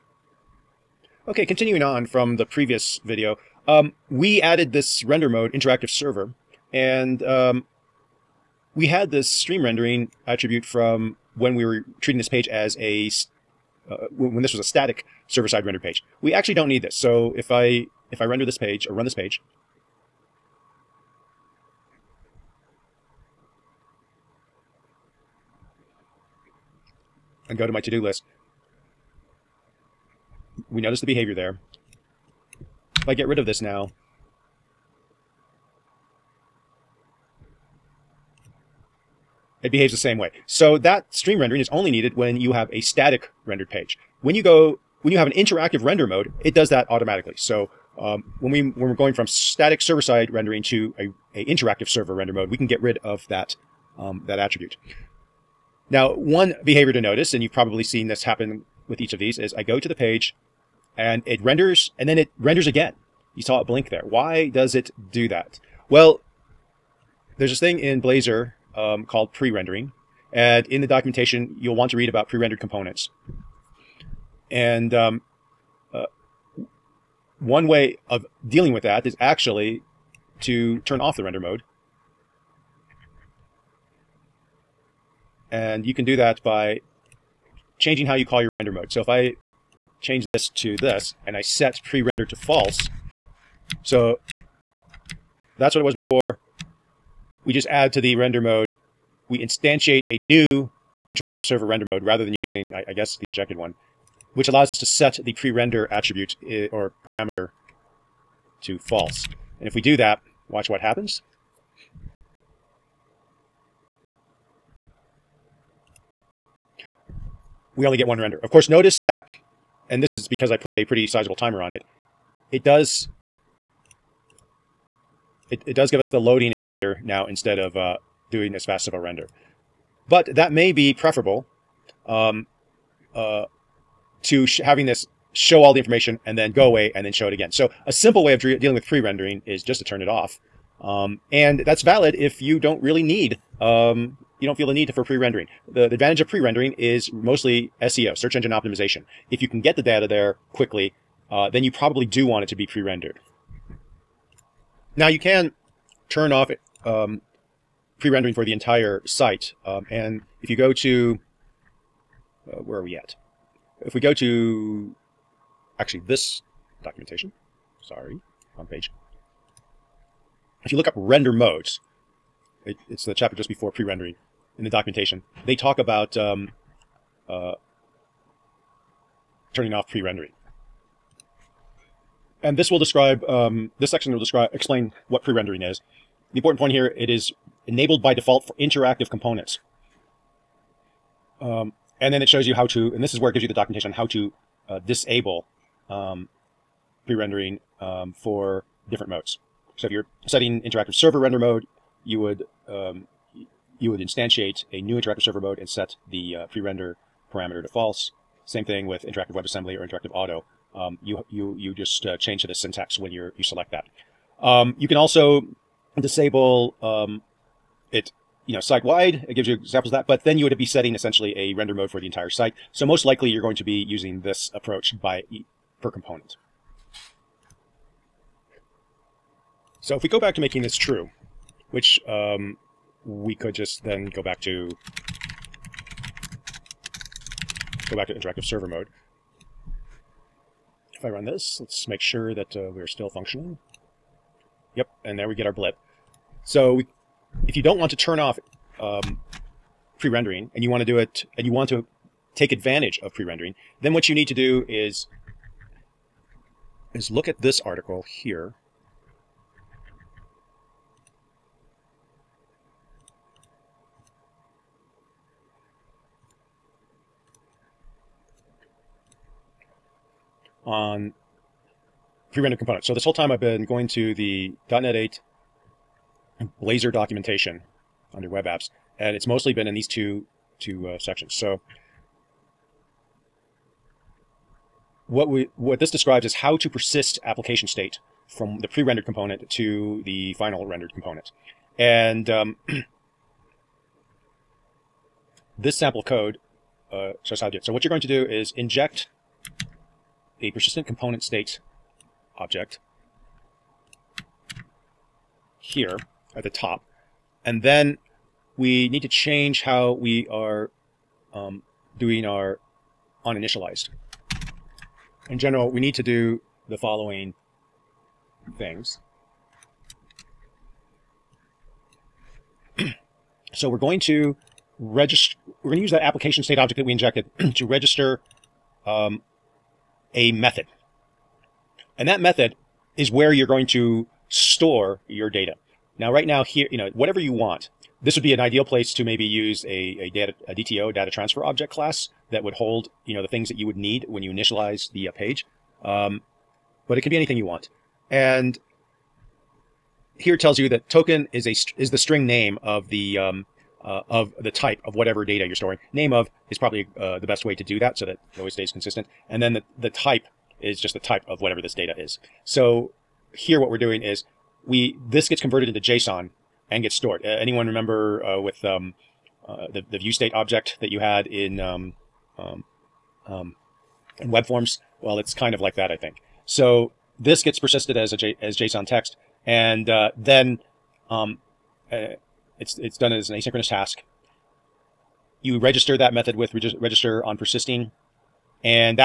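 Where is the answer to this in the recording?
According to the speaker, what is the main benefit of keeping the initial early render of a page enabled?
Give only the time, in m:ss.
2:28.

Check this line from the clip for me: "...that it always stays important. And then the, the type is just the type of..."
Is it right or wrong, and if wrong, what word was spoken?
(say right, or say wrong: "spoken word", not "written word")
wrong: "consistent", not "important".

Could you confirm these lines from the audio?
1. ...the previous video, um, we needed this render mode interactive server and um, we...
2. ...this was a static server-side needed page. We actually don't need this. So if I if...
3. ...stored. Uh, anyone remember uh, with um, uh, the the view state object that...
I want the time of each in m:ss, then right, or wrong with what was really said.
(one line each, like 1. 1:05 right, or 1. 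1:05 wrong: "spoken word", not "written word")
1. 0:02 wrong: "added", not "needed"
2. 0:14 wrong: "rendered", not "needed"
3. 6:06 right.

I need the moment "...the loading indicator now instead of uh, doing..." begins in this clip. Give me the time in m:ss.
2:06.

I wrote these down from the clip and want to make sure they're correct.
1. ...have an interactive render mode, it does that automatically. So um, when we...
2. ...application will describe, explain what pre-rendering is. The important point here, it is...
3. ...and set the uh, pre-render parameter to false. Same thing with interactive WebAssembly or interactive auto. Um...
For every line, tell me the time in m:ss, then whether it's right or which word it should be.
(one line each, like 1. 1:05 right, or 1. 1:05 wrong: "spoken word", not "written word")
1. 0:45 right
2. 3:03 wrong: "section", not "application"
3. 3:25 right.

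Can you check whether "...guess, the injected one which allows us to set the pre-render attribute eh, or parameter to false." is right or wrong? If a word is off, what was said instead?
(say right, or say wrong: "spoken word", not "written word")
right.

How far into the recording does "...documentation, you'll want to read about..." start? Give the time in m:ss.
1:10.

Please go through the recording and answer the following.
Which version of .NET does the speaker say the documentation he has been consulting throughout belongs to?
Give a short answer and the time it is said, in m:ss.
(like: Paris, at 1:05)
.NET 8, at 4:34.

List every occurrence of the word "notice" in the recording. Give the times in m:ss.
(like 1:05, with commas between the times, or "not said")
0:30, 0:56, 1:58.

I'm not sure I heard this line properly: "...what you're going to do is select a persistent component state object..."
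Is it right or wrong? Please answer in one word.
wrong.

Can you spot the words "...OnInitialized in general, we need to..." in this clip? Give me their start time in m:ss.
5:13.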